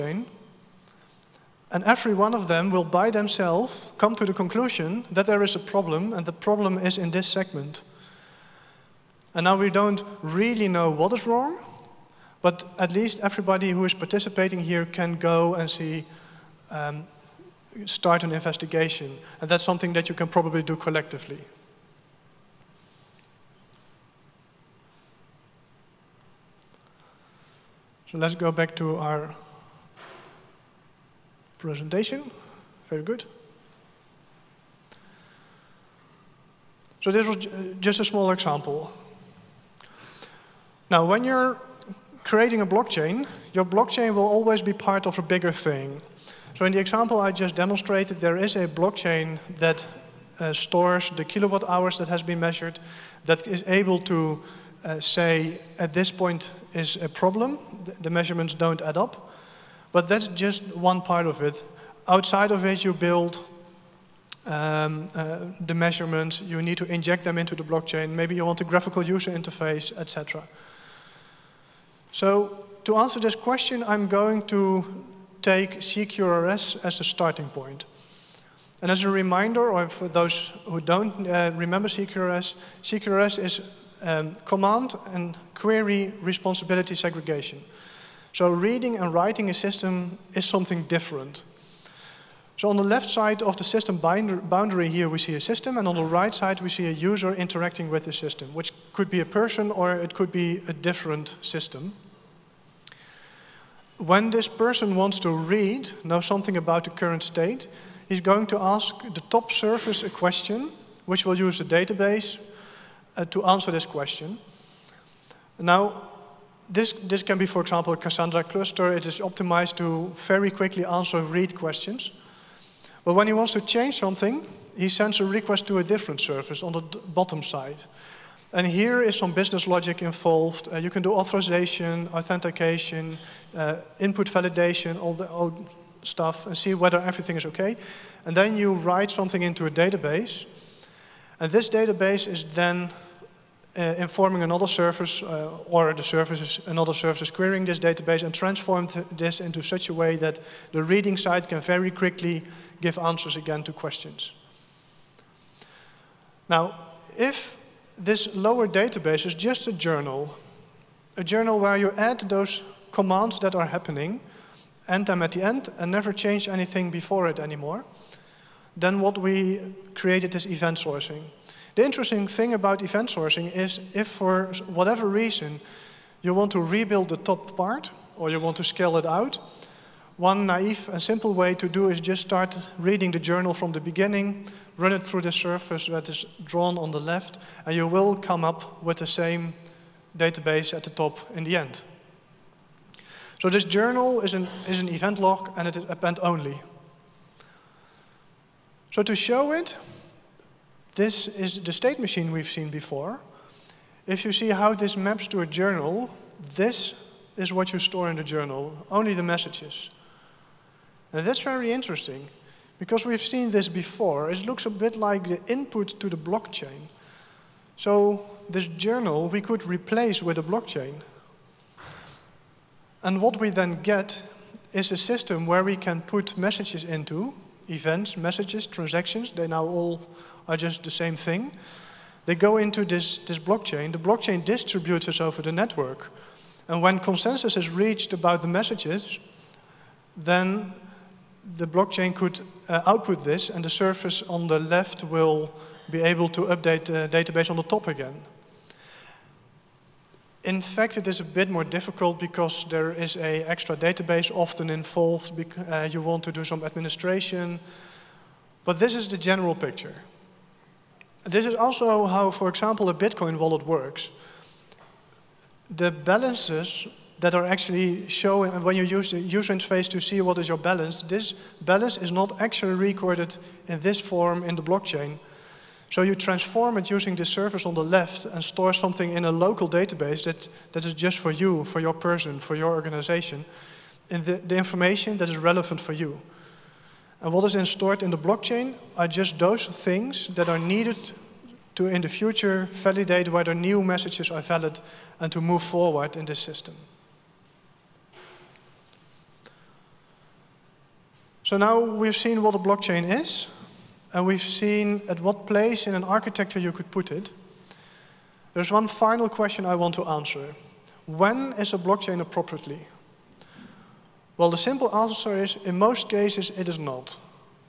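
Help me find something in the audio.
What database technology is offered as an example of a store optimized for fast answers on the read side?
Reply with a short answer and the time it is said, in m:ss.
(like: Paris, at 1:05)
Cassandra, at 1:57.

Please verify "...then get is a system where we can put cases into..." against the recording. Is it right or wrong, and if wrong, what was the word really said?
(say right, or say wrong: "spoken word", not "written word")
wrong: "messages", not "cases".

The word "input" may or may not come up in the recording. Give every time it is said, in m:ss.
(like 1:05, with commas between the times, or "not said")
2:13, 3:35.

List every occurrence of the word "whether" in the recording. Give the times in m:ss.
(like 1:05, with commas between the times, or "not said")
2:16, 4:53.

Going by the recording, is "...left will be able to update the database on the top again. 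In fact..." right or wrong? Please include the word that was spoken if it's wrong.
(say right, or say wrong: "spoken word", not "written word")
right.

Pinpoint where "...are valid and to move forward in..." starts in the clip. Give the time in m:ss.
4:54.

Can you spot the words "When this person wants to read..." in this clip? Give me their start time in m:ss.
1:43.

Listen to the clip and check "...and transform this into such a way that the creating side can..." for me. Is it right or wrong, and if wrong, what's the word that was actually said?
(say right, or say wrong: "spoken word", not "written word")
wrong: "reading", not "creating".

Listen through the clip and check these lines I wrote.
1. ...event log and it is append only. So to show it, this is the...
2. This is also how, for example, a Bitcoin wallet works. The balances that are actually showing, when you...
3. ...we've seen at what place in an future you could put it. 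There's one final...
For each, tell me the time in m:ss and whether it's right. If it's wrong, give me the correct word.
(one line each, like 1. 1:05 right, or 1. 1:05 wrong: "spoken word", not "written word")
1. 3:14 right
2. 4:21 right
3. 5:04 wrong: "architecture", not "future".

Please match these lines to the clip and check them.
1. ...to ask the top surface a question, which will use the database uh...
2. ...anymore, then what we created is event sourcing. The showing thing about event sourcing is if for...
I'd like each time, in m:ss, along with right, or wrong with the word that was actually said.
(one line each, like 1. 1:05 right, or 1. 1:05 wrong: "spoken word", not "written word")
1. 1:48 right
2. 2:47 wrong: "interesting", not "showing".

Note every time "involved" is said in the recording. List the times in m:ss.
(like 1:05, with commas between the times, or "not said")
2:10, 4:14.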